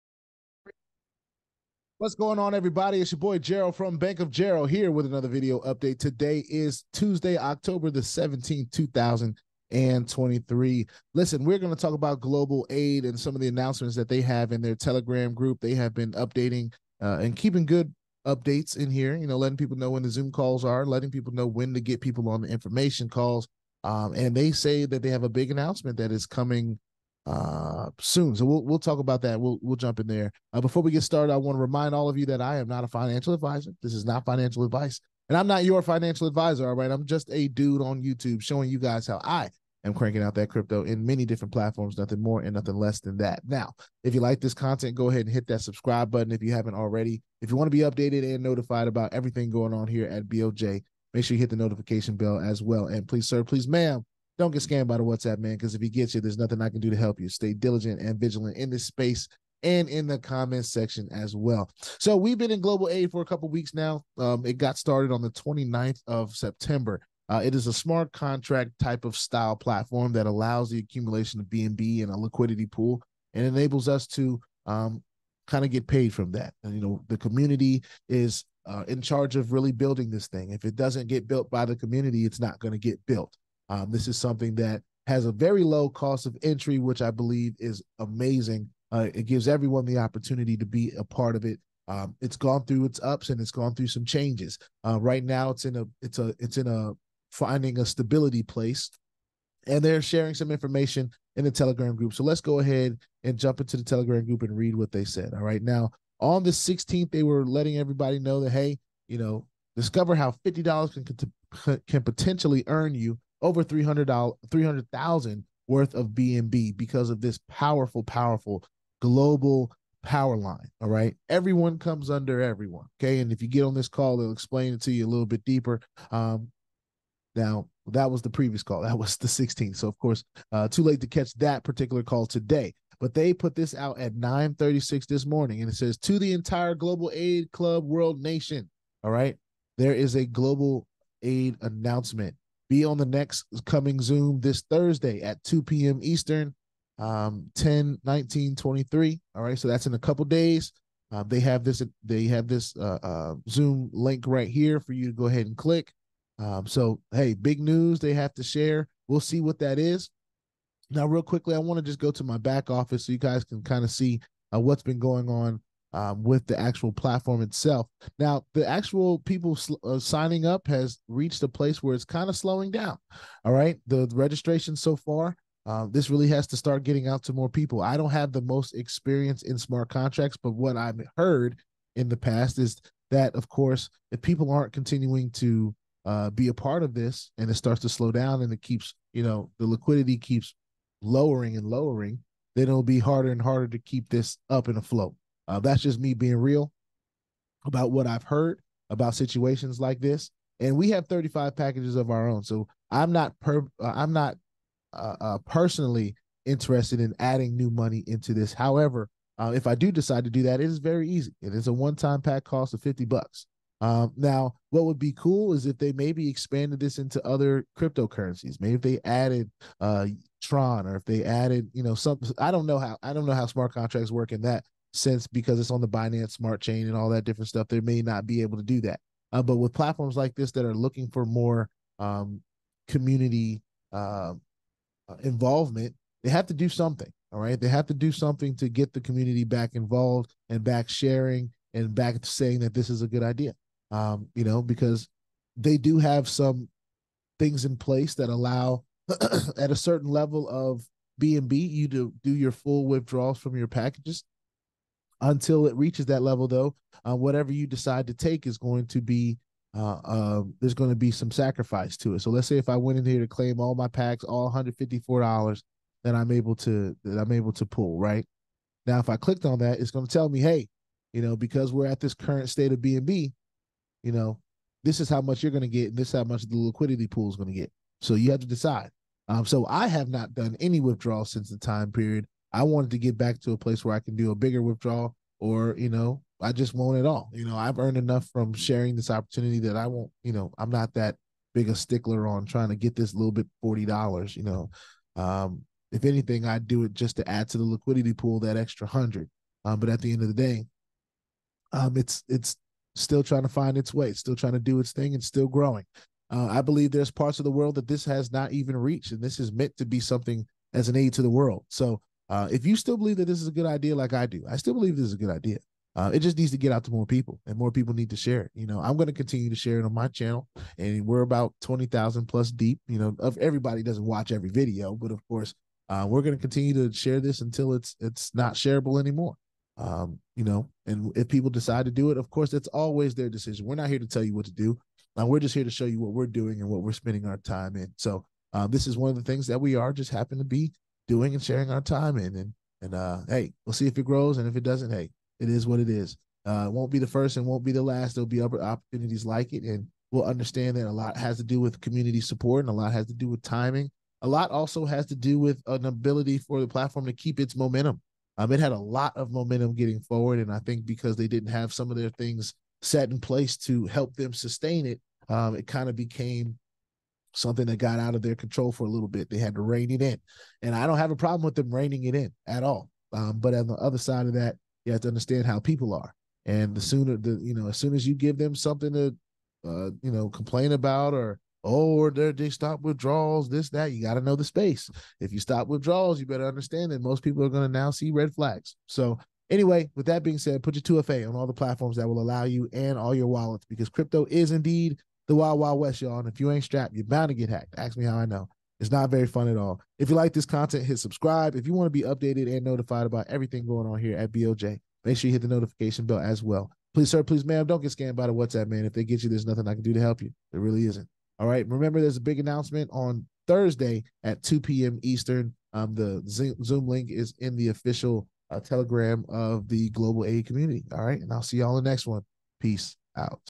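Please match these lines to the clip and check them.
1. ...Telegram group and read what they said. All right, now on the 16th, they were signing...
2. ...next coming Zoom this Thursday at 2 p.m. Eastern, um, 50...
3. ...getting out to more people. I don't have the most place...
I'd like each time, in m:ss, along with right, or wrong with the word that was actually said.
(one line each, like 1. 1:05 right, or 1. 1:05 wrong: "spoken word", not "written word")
1. 1:43 wrong: "letting", not "signing"
2. 2:23 wrong: "10", not "50"
3. 2:56 wrong: "experience", not "place".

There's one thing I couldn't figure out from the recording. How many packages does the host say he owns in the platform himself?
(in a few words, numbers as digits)
35.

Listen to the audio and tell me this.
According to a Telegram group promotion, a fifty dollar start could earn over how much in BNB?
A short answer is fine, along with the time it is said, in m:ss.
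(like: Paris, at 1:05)
$300, at 1:53.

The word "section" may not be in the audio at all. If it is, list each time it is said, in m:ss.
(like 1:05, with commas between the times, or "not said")
1:00.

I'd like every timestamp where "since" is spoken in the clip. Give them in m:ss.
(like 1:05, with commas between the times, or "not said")
3:44, 4:41.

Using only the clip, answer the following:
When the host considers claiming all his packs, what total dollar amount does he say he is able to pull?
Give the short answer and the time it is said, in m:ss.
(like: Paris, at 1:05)
$154, at 4:24.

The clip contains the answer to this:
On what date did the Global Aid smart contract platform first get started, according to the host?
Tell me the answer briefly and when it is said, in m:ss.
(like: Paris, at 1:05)
September 29, at 1:05.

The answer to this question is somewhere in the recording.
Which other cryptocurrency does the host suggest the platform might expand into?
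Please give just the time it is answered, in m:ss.
3:40.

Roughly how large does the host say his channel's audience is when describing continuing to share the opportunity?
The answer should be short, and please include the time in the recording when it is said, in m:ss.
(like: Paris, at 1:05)
20,000, at 5:21.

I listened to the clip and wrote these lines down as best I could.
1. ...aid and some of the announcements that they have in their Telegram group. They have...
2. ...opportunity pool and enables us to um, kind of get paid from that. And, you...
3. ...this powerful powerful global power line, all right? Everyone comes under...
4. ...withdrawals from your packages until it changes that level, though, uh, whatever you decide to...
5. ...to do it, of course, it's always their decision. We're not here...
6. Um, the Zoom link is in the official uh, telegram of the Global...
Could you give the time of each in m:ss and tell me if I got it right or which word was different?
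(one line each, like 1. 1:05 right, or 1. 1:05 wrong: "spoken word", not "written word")
1. 0:12 right
2. 1:12 wrong: "liquidity", not "opportunity"
3. 1:57 right
4. 4:12 wrong: "reaches", not "changes"
5. 5:31 right
6. 6:55 right.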